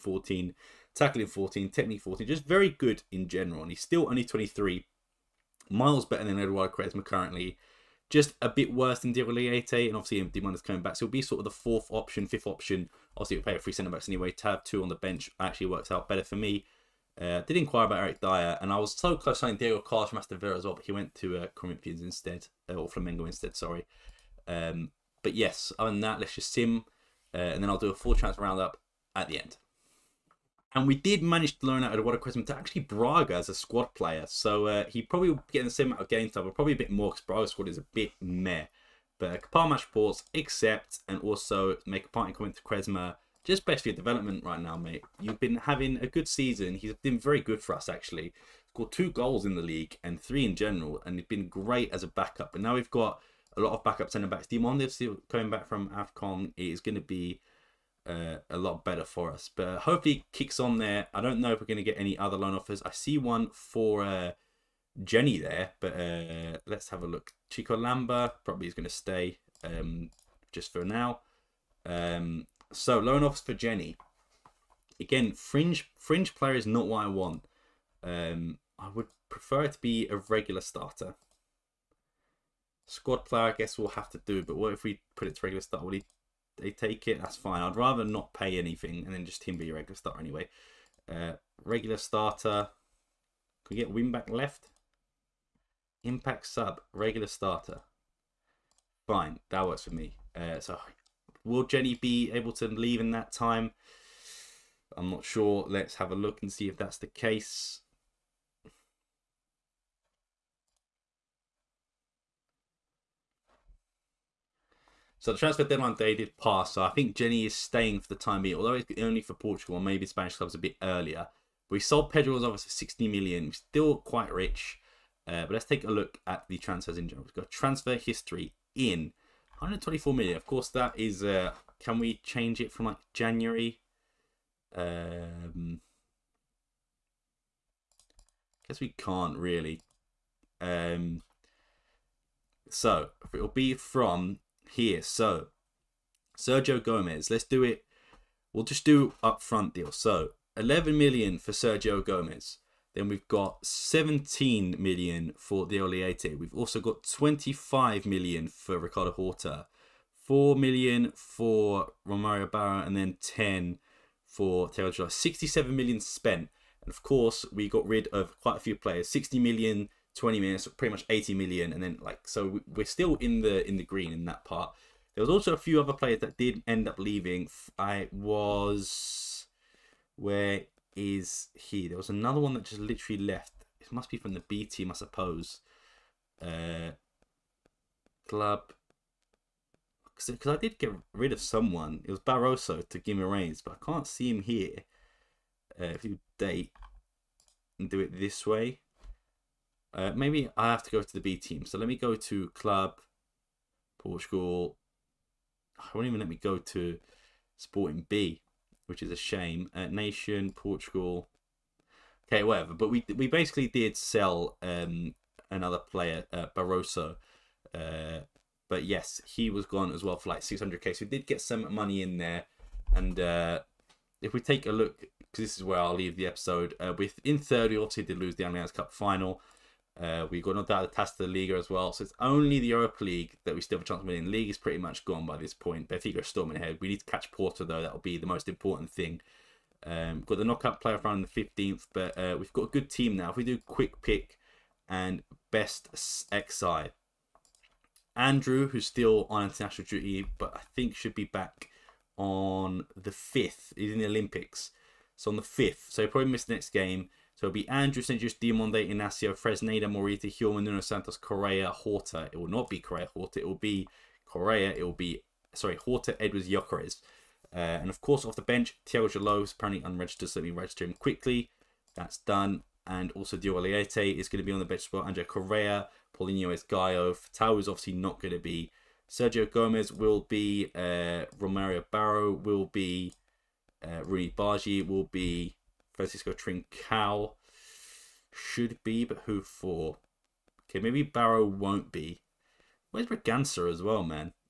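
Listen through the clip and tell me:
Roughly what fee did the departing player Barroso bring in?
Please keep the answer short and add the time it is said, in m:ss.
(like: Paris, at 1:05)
600k, at 3:40.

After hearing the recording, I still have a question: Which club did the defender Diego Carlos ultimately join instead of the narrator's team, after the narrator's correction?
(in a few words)
Flamengo.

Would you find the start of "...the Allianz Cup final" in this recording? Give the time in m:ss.
3:48.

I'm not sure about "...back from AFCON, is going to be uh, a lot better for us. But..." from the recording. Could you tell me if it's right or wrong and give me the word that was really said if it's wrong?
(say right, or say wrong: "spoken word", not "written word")
right.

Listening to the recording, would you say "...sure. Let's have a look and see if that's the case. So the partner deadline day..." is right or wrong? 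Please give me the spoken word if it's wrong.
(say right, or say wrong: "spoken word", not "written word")
wrong: "transfer", not "partner".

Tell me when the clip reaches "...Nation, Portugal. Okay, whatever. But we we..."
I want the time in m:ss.
3:29.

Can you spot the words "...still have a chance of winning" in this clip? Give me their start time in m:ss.
3:53.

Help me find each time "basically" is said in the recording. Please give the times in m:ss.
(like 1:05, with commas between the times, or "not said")
0:43, 3:33.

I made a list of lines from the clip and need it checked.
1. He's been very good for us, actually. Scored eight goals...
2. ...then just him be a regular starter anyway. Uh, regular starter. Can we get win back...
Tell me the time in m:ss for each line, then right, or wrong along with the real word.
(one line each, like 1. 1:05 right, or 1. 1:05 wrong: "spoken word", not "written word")
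1. 0:46 wrong: "two", not "eight"
2. 1:29 right.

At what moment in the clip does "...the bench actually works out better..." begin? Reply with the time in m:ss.
0:14.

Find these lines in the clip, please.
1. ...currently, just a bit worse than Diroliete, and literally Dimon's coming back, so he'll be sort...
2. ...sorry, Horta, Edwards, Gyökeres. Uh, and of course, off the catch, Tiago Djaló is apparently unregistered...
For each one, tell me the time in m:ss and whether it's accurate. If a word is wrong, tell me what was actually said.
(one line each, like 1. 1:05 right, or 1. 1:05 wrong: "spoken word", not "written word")
1. 0:07 wrong: "obviously", not "literally"
2. 4:25 wrong: "bench", not "catch".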